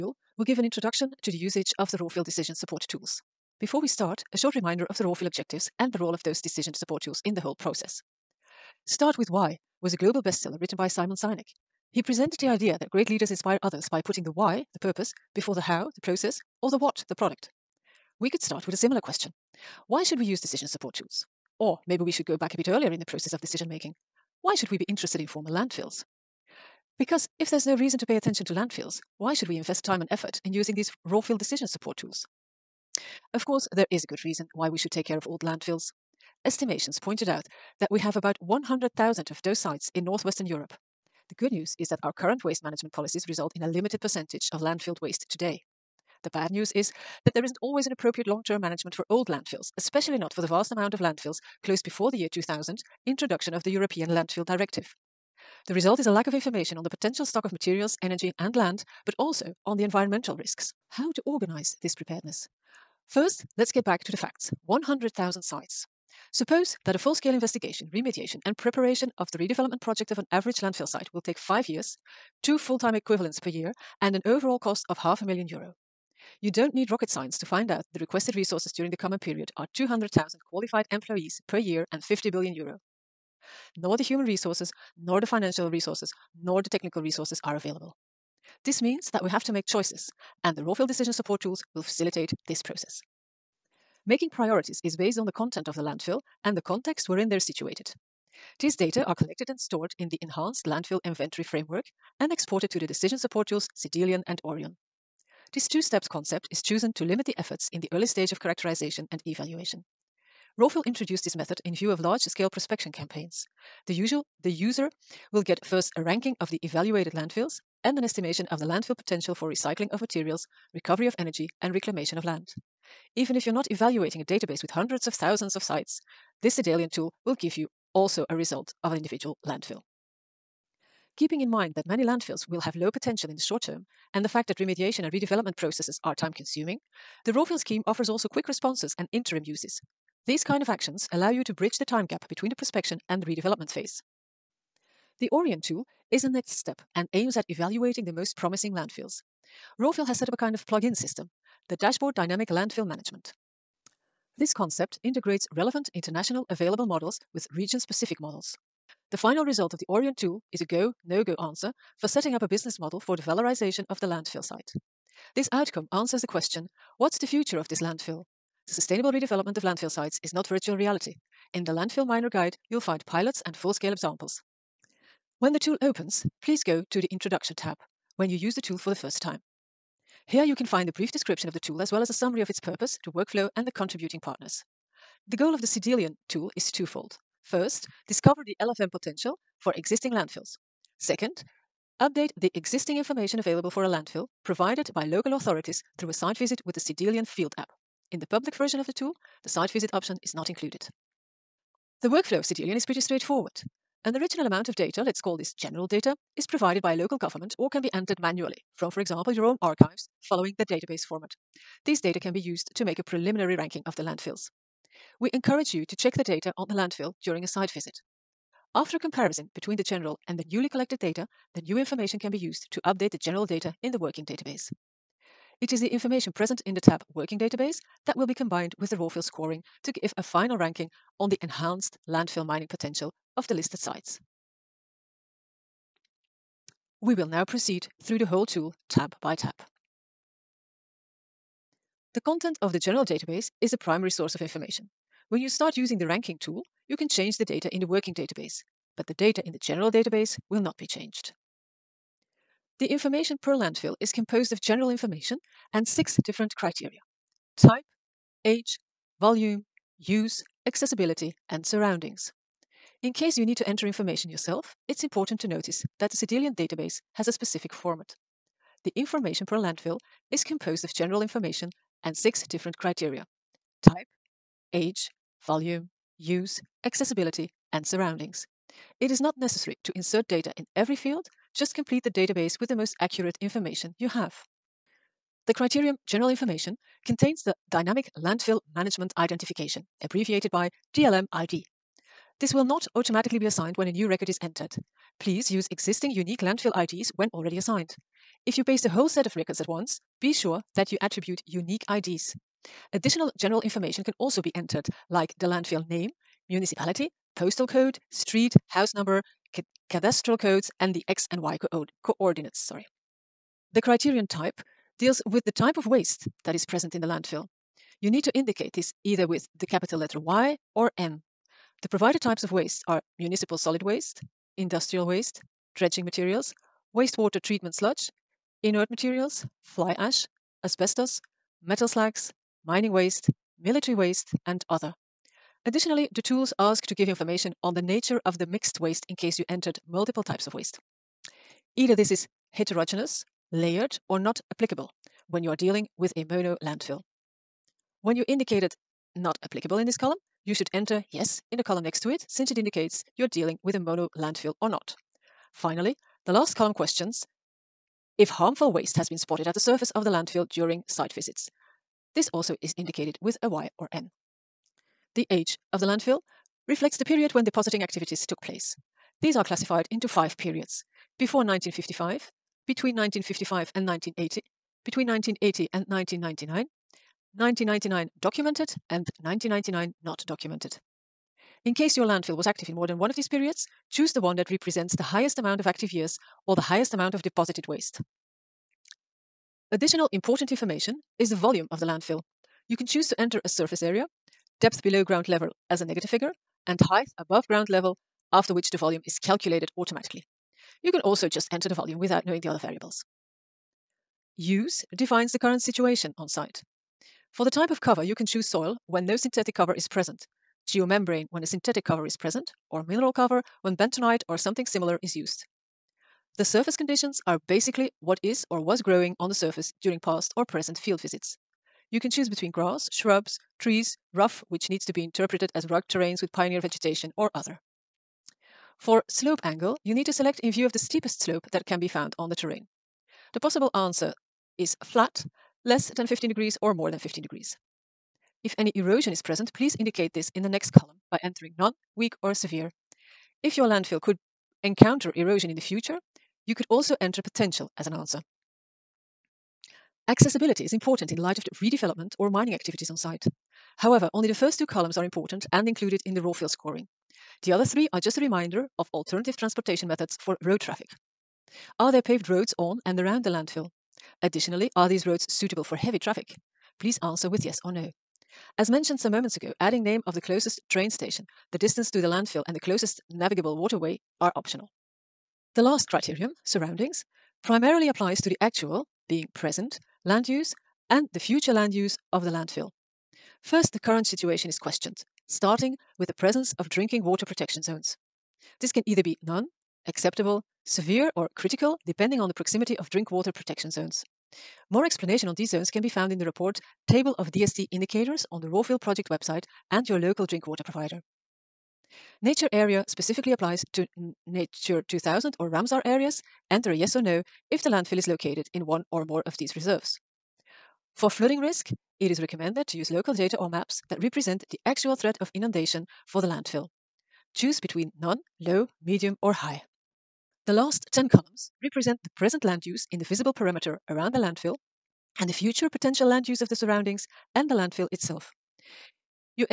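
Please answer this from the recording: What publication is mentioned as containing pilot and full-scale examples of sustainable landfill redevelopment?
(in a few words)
Landfill Miner Guide.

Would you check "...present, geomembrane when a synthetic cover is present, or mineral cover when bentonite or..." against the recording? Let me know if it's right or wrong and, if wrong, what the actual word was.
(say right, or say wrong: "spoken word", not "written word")
right.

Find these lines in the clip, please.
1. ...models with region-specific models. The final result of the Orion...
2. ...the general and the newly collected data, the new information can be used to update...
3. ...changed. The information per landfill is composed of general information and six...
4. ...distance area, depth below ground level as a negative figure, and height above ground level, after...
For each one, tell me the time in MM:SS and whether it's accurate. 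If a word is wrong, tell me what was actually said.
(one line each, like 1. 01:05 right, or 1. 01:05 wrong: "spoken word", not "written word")
1. 02:36 right
2. 03:39 right
3. 04:10 right
4. 06:33 wrong: "surface", not "distance".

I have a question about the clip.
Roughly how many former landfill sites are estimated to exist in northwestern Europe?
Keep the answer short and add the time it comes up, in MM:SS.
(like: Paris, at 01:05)
100,000, at 00:38.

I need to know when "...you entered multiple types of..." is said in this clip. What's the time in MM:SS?
05:39.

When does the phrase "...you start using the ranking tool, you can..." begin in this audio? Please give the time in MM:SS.
04:05.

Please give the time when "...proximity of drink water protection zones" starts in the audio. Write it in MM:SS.
08:12.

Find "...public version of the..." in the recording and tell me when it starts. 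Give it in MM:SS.
03:18.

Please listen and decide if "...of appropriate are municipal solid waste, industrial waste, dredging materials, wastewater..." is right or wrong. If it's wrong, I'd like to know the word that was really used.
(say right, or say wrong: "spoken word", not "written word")
wrong: "waste", not "appropriate".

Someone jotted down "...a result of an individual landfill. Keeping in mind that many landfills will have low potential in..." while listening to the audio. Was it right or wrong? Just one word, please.
right.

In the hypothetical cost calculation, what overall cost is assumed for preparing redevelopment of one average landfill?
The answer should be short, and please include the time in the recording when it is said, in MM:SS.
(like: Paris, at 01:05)
half a million euro, at 01:15.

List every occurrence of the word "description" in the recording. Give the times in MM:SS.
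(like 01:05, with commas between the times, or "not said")
03:01.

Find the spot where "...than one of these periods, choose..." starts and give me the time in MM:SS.
06:22.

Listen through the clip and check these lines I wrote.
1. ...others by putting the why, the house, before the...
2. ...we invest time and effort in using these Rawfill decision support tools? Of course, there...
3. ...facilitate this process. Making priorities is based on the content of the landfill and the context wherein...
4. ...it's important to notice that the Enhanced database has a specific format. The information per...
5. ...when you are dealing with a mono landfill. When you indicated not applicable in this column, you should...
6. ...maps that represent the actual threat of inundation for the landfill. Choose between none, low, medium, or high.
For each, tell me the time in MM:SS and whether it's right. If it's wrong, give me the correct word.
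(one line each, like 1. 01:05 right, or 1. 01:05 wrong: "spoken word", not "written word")
1. 00:13 wrong: "purpose", not "house"
2. 00:29 right
3. 01:31 right
4. 04:24 wrong: "Cedalion", not "Enhanced"
5. 05:45 right
6. 08:33 right.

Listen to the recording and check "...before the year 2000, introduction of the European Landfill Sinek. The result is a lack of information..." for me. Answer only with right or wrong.
wrong.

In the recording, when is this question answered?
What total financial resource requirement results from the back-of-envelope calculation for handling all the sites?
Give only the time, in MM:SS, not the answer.
01:22.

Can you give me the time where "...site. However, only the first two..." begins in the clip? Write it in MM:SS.
07:32.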